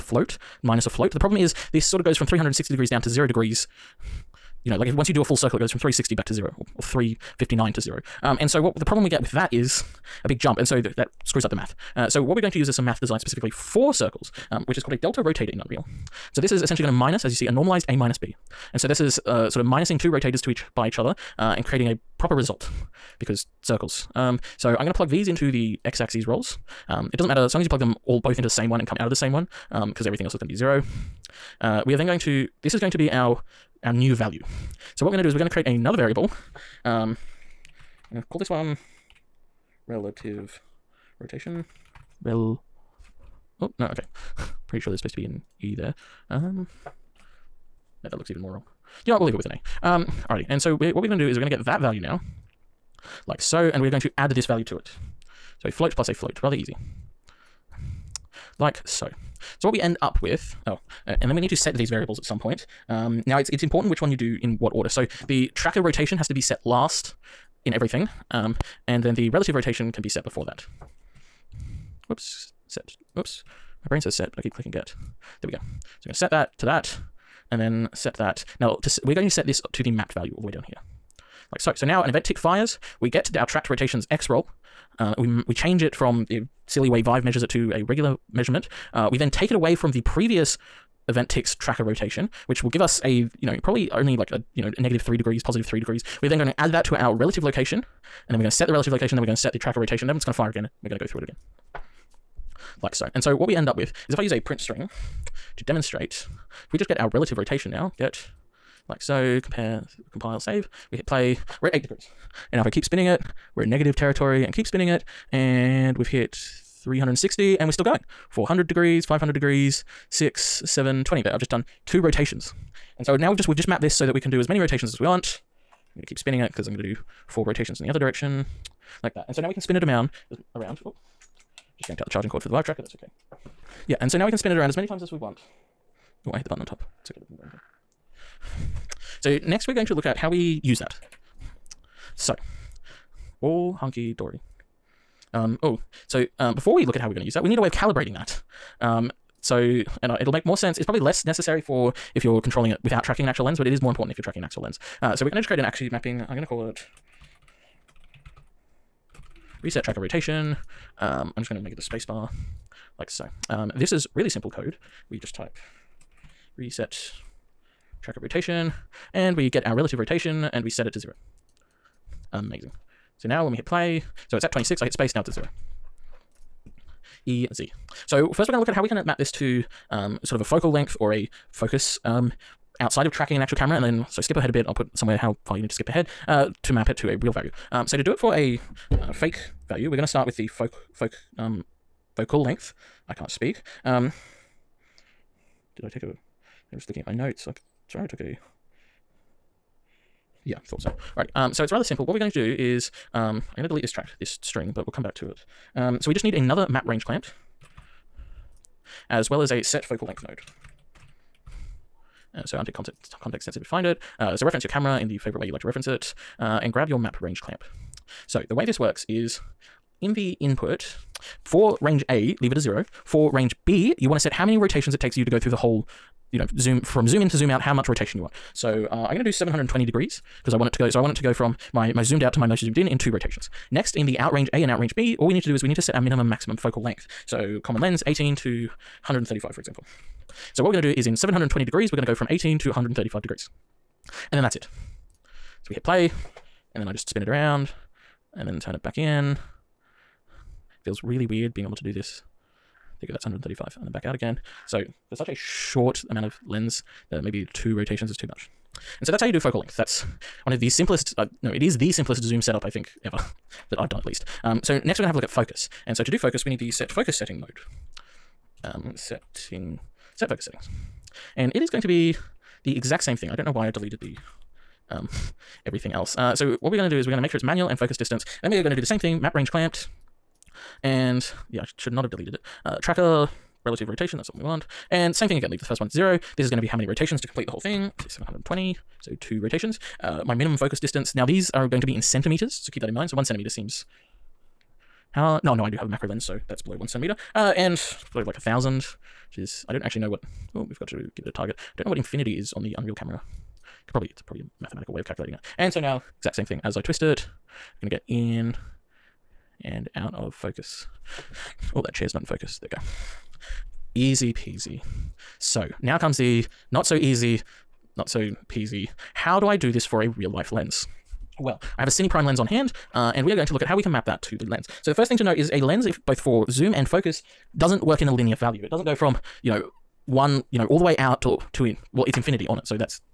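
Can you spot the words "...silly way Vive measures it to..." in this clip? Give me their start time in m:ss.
1:26.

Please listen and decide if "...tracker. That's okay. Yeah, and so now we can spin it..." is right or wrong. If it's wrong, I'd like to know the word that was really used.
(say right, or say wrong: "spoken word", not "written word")
right.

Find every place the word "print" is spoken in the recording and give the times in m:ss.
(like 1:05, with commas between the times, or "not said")
1:44.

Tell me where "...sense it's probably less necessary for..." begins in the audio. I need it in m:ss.
2:30.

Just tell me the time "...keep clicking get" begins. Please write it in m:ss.
1:14.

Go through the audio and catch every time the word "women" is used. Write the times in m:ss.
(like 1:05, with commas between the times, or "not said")
not said.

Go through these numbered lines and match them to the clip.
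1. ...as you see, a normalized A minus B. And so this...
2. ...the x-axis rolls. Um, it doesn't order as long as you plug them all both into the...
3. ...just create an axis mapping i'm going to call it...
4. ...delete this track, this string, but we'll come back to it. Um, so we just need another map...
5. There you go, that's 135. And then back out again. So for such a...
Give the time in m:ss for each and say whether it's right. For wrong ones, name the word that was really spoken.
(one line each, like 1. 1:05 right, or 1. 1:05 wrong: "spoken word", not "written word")
1. 0:17 right
2. 0:25 wrong: "matter", not "order"
3. 2:35 right
4. 3:23 right
5. 4:13 right.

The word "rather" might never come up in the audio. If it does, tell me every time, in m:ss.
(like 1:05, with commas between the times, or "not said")
0:56, 3:21.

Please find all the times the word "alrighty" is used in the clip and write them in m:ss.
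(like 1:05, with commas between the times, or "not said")
0:50, 3:21.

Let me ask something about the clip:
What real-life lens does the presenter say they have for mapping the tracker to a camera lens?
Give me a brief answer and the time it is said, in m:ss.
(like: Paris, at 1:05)
Cine Prime lens, at 5:21.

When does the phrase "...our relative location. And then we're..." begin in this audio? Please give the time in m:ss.
1:36.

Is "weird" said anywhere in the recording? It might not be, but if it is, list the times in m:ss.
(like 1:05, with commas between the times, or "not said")
4:11.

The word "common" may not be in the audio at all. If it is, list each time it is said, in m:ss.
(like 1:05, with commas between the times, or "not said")
3:57.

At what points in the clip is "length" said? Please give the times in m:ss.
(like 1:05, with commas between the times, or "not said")
3:00, 3:12, 3:30, 3:56, 4:19.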